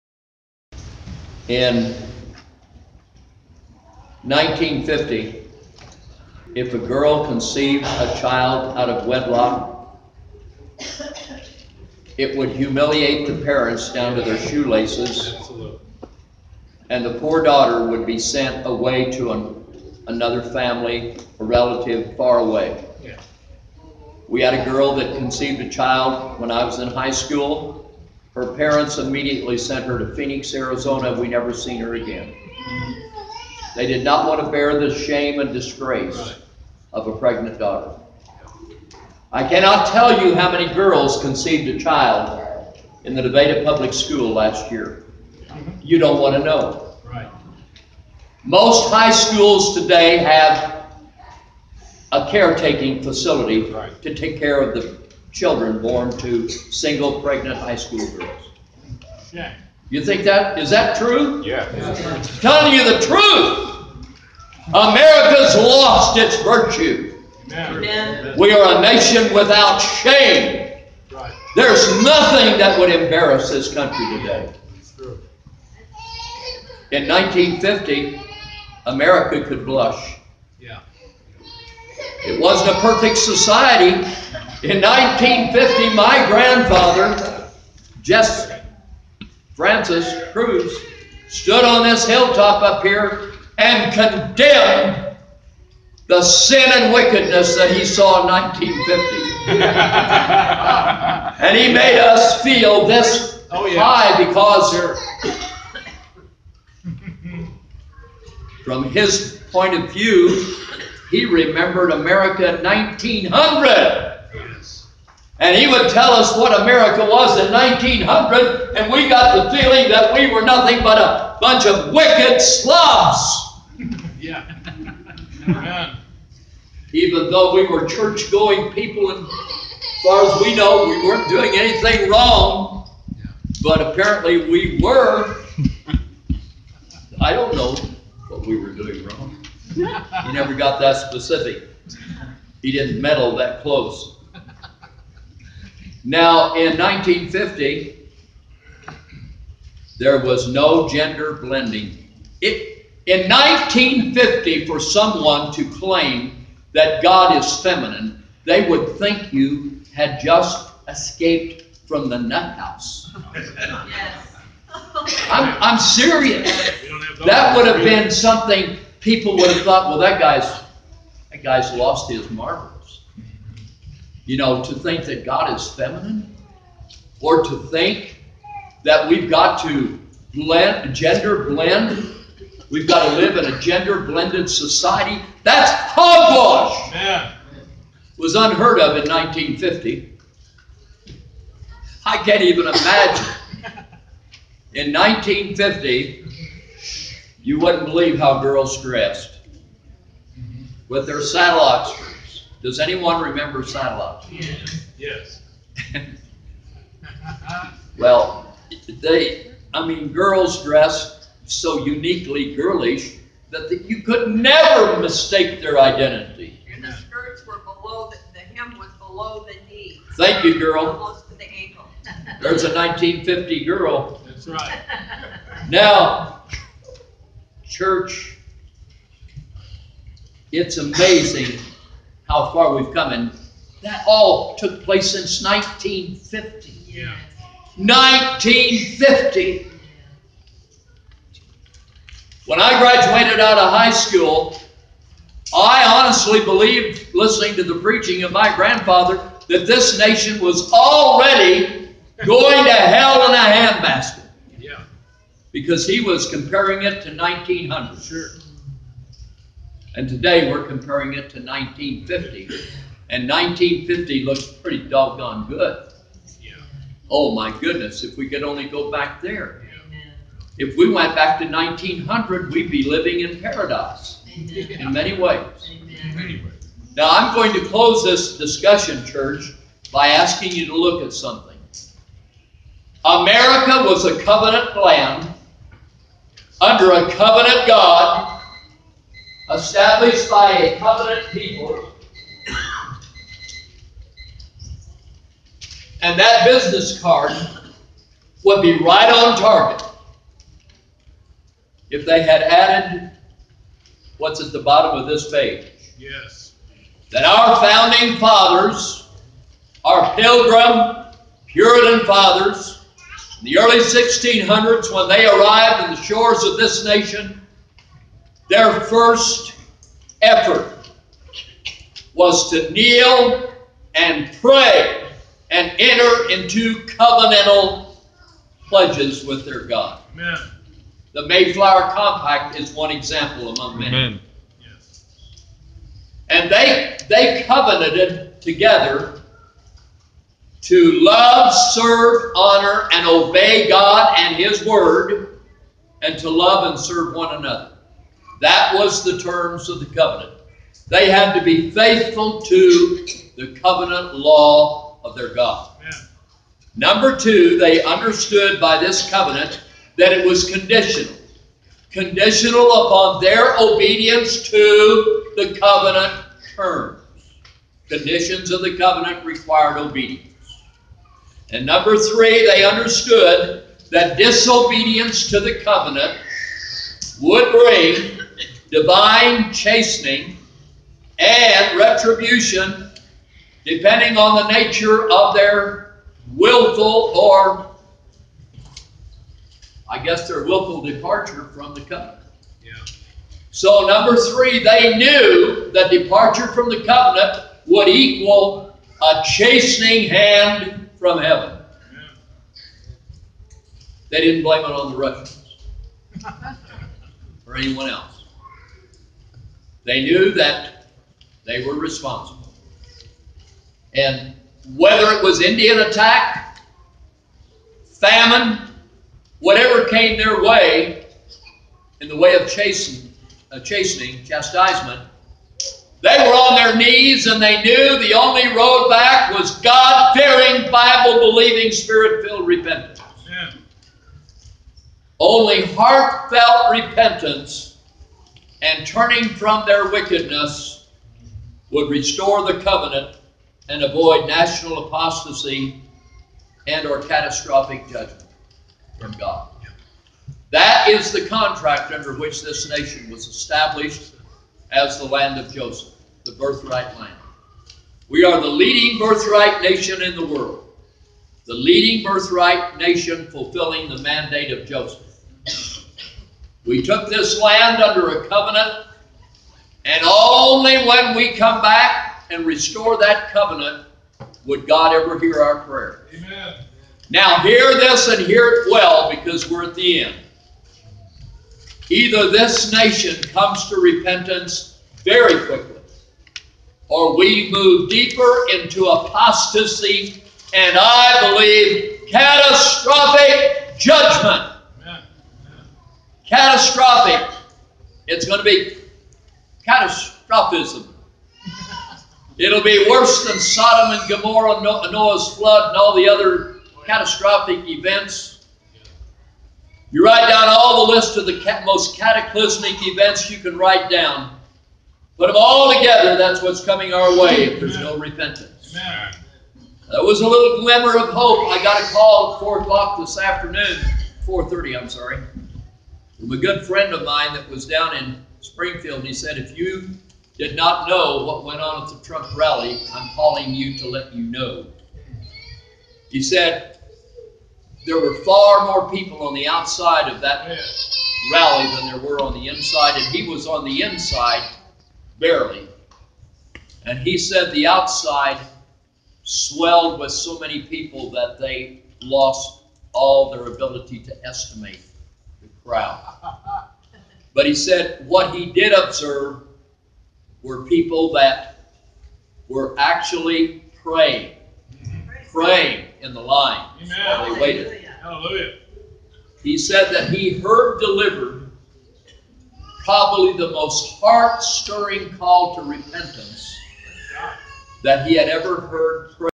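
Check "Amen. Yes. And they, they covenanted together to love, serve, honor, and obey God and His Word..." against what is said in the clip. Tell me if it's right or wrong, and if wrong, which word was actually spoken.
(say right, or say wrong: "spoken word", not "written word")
right.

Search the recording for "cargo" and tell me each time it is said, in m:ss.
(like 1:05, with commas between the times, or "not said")
not said.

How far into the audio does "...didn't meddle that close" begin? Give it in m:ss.
2:22.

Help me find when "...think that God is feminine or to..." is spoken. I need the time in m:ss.
2:54.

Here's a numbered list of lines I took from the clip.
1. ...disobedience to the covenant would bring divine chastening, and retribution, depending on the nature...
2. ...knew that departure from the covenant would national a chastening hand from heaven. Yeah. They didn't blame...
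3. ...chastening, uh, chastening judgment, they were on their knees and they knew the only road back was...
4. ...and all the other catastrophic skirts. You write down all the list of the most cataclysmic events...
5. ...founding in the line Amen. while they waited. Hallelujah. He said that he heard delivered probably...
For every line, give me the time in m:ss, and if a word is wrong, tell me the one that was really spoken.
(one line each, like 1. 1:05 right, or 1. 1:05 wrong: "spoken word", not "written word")
1. 6:14 right
2. 6:34 wrong: "equal", not "national"
3. 7:02 wrong: "chastisement", not "judgment"
4. 8:25 wrong: "events", not "skirts"
5. 9:25 wrong: "praying", not "founding".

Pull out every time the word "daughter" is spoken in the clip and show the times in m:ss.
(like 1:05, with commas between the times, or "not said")
0:17, 0:37.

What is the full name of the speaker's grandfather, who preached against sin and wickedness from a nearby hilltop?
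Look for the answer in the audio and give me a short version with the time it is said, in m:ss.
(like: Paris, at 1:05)
Jess Francis Cruz, at 1:28.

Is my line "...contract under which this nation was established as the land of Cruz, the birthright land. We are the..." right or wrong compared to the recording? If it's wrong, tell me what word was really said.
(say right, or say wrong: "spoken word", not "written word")
wrong: "Joseph", not "Cruz".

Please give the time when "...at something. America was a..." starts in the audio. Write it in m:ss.
4:41.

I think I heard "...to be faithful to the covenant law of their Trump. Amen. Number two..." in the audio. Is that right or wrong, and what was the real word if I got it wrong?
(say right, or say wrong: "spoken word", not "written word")
wrong: "God", not "Trump".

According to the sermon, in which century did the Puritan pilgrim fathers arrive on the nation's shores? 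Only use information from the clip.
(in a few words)
1600s.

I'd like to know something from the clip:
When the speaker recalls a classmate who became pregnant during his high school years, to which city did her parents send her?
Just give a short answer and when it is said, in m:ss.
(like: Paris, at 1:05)
Phoenix, Arizona, at 0:30.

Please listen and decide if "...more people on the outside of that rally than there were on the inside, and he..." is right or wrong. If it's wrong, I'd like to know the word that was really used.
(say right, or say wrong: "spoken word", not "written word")
right.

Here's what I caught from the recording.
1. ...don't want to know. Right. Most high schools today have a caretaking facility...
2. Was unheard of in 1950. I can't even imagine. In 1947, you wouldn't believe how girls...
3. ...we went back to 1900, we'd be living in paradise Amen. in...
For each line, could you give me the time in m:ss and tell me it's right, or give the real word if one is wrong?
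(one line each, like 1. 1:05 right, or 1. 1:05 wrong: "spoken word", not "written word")
1. 0:45 right
2. 3:08 wrong: "1950", not "1947"
3. 4:30 right.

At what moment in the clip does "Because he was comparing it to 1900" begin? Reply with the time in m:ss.
4:15.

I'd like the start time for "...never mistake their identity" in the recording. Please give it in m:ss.
3:34.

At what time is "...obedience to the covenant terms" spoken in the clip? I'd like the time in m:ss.
6:03.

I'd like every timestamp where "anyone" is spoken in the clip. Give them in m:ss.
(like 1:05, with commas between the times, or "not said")
3:22, 6:47.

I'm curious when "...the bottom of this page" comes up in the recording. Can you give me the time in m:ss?
5:04.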